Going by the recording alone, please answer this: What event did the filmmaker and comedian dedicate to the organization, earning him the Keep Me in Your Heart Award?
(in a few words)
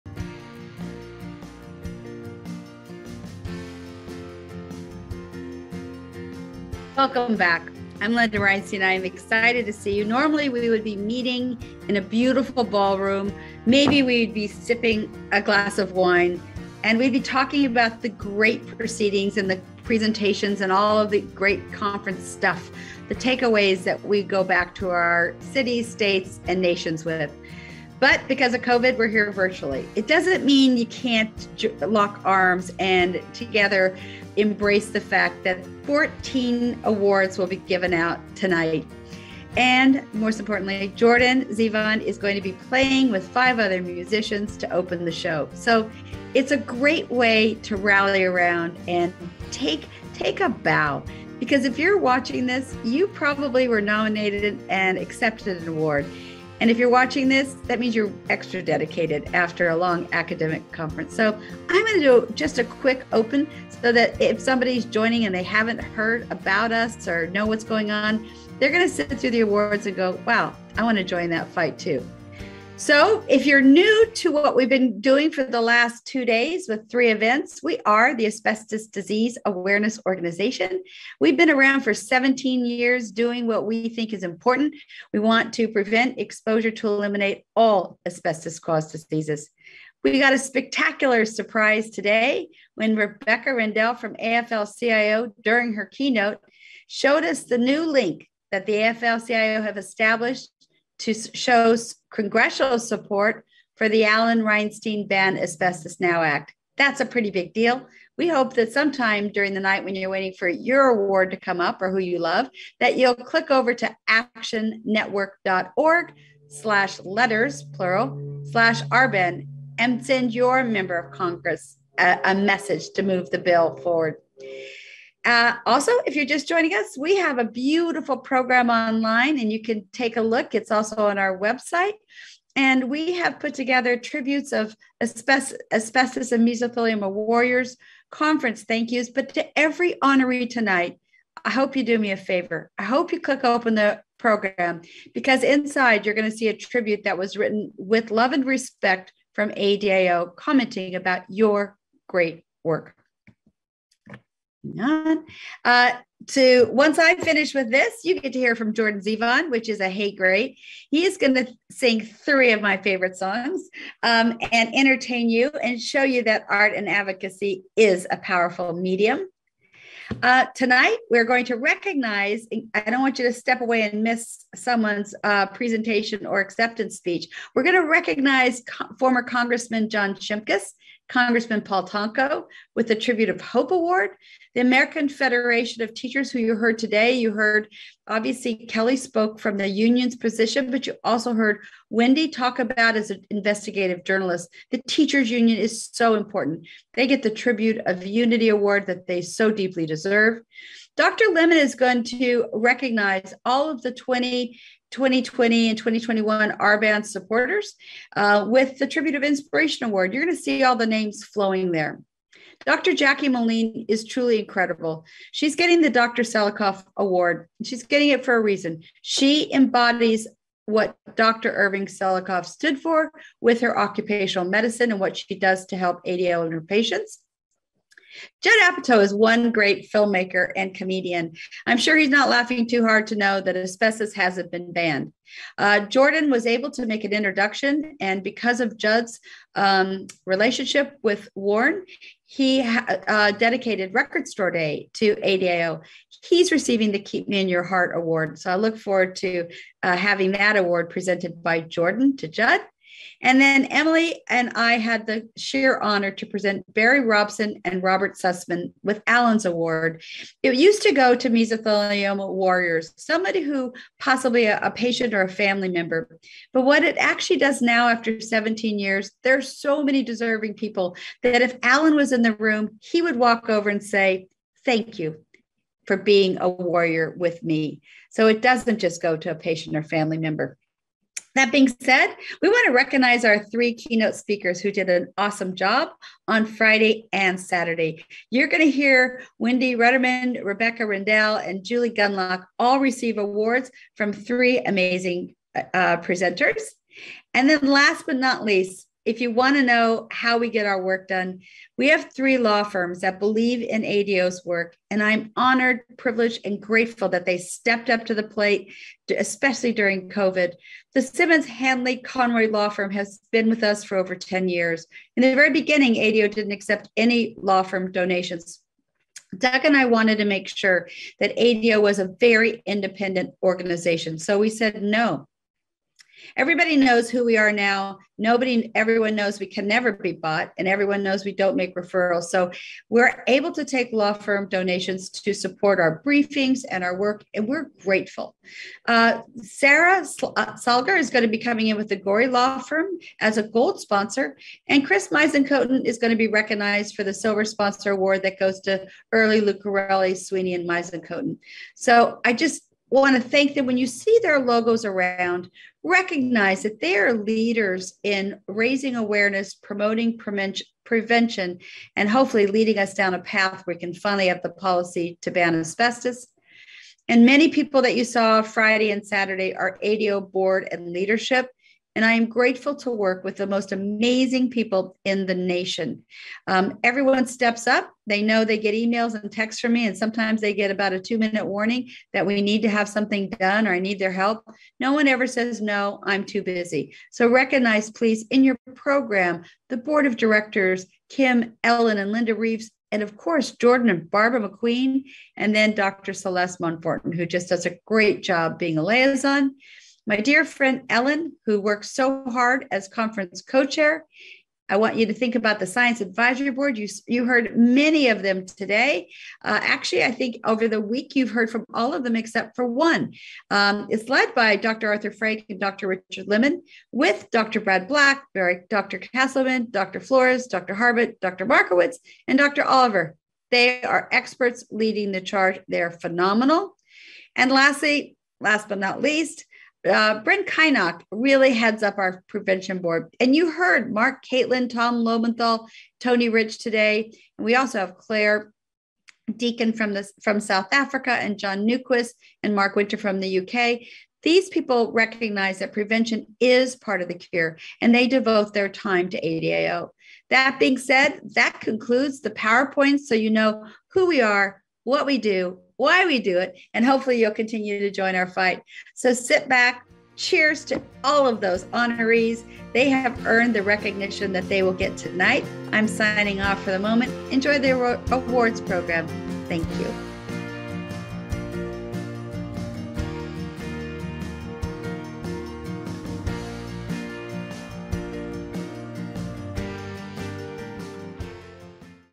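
Record Store Day.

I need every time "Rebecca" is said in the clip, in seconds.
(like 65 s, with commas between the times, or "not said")
92 s, 290 s.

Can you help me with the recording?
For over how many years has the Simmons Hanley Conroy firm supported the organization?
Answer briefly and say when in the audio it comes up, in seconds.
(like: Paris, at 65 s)
10, at 314 s.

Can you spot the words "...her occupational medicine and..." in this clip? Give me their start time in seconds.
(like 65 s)
223 s.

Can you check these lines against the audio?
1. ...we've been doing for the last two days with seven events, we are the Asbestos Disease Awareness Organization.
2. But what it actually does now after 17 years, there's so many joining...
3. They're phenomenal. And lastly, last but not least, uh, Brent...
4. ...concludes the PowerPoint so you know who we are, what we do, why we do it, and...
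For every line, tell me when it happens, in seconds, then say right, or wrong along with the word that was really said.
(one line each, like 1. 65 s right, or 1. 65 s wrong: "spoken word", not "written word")
1. 74 s wrong: "three", not "seven"
2. 266 s wrong: "deserving", not "joining"
3. 425 s right
4. 451 s right.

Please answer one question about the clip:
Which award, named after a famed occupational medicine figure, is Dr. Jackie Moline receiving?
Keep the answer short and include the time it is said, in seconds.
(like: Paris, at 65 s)
Dr. Selikoff Award, at 215 s.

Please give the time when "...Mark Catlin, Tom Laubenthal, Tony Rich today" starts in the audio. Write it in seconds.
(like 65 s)
433 s.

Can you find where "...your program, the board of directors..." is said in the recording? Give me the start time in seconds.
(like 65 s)
388 s.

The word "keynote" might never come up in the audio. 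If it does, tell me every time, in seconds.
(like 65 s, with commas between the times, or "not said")
95 s, 283 s.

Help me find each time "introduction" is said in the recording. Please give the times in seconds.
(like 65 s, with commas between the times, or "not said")
237 s.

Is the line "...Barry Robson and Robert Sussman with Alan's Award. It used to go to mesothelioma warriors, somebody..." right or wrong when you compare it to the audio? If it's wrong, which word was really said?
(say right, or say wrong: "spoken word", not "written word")
right.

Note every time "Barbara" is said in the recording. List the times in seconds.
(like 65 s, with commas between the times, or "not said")
394 s.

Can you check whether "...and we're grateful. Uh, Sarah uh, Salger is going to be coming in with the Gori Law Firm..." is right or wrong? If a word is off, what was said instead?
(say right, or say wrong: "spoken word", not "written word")
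right.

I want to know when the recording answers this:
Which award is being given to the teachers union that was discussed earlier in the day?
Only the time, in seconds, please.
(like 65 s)
197 s.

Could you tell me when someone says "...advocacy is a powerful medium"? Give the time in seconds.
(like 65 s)
166 s.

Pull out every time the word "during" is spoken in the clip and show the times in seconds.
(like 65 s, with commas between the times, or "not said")
95 s, 109 s, 309 s.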